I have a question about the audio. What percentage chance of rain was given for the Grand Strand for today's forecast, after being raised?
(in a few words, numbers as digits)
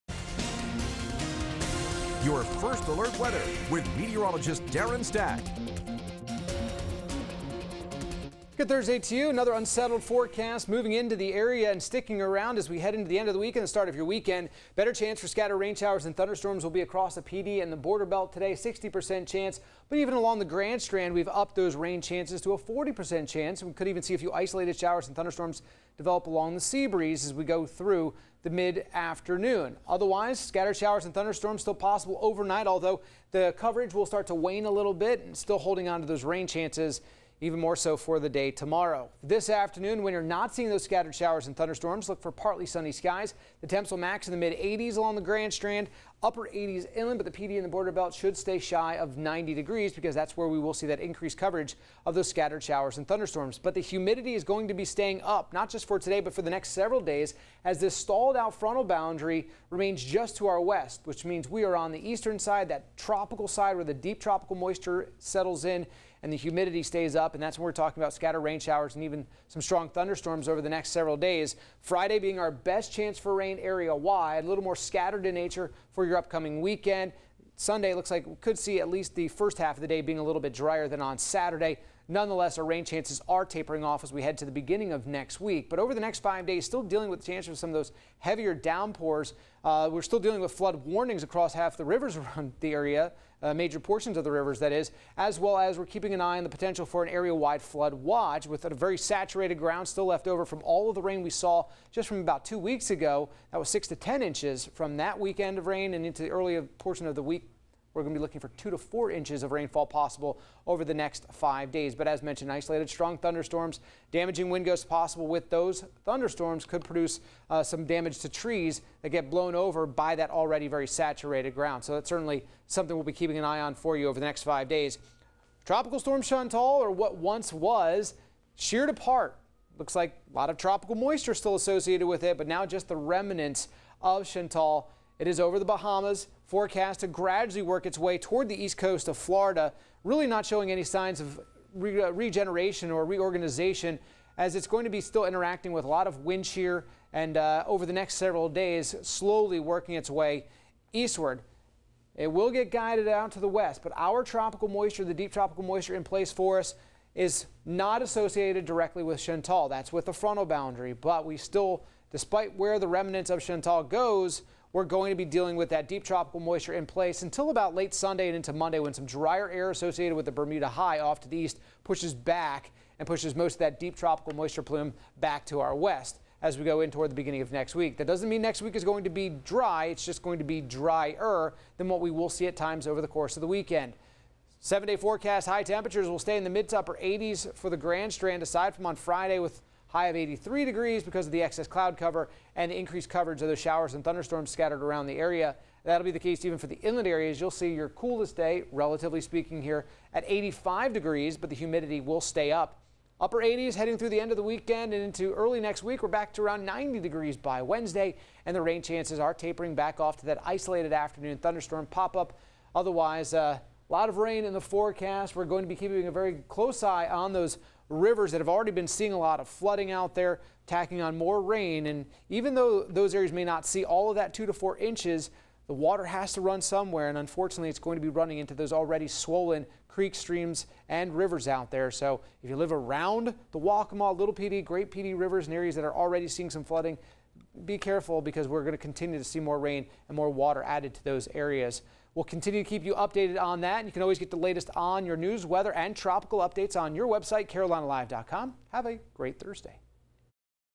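40%.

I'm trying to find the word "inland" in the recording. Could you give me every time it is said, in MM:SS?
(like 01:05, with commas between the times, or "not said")
00:46, 03:16.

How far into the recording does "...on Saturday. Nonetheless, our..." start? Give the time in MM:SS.
01:21.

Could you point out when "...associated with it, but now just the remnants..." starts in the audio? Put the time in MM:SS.
02:11.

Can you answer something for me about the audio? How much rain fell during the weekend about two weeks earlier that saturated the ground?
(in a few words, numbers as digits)
6 to 10 inches.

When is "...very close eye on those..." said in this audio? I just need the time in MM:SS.
03:36.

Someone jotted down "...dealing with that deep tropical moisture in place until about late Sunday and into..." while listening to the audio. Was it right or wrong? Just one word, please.
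right.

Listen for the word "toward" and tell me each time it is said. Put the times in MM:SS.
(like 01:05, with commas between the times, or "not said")
02:18, 02:56.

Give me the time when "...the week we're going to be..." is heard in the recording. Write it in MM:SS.
01:47.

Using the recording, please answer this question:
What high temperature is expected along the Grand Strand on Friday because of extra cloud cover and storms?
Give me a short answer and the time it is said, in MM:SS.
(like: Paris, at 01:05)
83 degrees, at 03:10.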